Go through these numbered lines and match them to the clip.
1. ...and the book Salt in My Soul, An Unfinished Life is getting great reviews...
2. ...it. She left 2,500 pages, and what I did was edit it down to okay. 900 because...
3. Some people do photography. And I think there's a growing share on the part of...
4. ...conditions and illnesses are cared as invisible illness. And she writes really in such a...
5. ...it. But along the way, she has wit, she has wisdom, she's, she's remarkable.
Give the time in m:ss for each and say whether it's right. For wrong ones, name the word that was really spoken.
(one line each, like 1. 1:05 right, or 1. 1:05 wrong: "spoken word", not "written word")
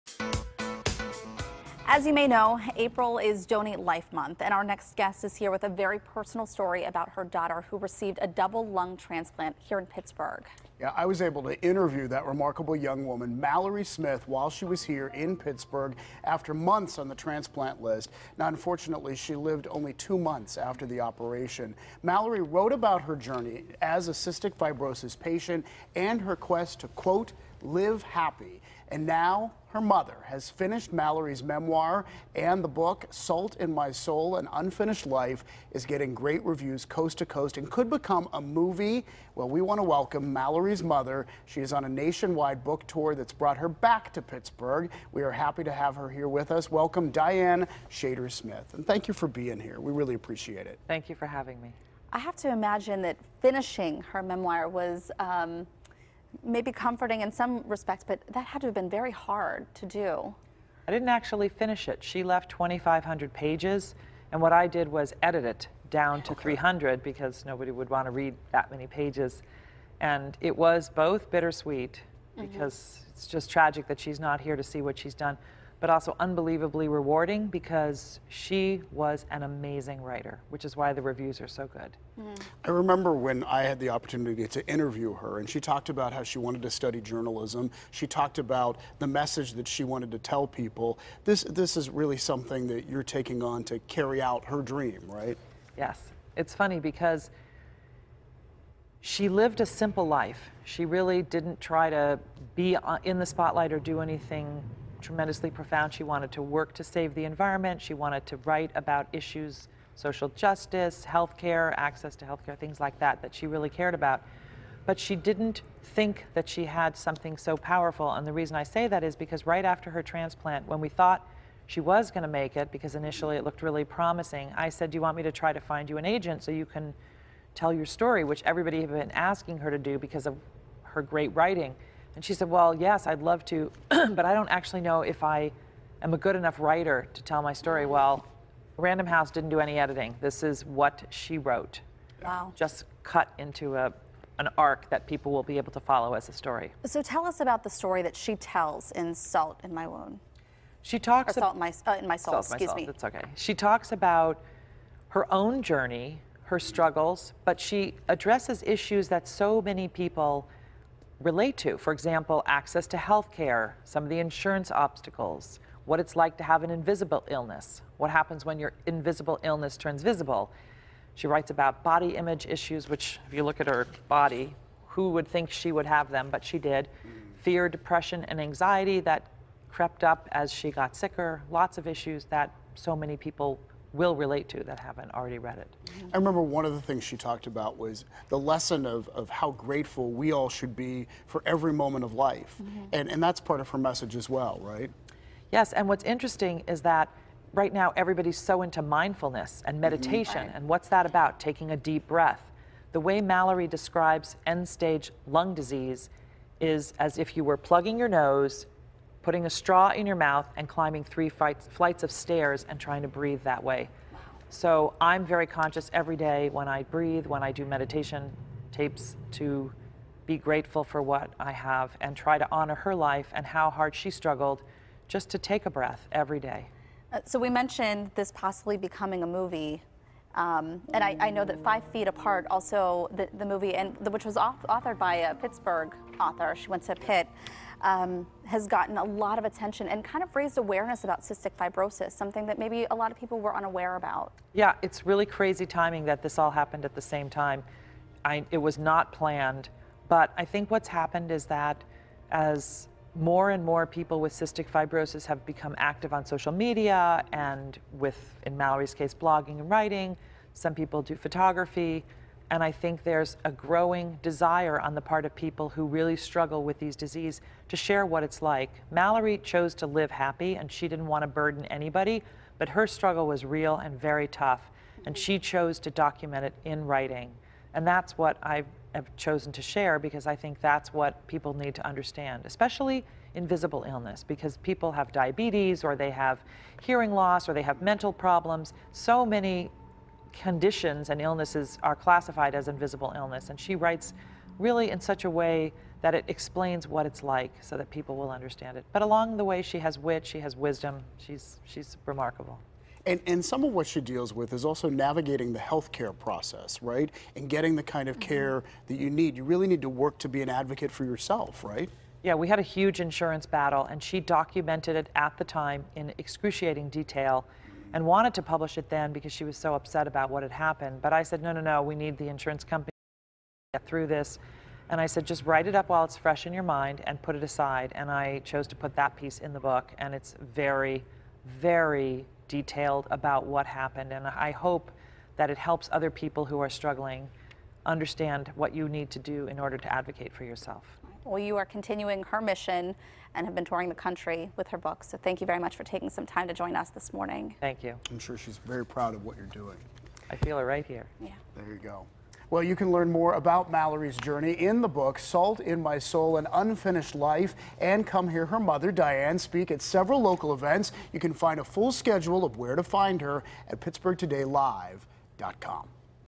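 1. 0:32 right
2. 1:01 wrong: "300", not "900"
3. 4:20 wrong: "desire", not "share"
4. 4:50 wrong: "classified", not "cared"
5. 4:58 right.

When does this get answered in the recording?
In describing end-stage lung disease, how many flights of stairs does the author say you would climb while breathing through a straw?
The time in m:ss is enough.
3:31.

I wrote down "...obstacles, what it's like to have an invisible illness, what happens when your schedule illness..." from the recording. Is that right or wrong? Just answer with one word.
wrong.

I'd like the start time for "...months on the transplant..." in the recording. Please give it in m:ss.
0:16.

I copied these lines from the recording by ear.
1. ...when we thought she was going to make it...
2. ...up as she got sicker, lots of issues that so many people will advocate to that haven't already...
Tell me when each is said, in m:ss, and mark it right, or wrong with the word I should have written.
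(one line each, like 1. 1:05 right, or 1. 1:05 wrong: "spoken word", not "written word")
1. 2:00 right
2. 3:00 wrong: "relate", not "advocate".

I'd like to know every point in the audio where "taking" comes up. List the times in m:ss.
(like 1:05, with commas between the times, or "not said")
1:33, 3:21, 5:45.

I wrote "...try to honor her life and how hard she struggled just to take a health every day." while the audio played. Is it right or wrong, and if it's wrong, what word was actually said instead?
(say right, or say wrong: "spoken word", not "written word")
wrong: "breath", not "health".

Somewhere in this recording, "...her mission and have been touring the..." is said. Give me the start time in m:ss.
5:42.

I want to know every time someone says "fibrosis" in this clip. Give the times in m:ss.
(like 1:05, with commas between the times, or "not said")
0:24, 4:01, 4:14.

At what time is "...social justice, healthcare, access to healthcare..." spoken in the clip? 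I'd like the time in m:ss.
1:49.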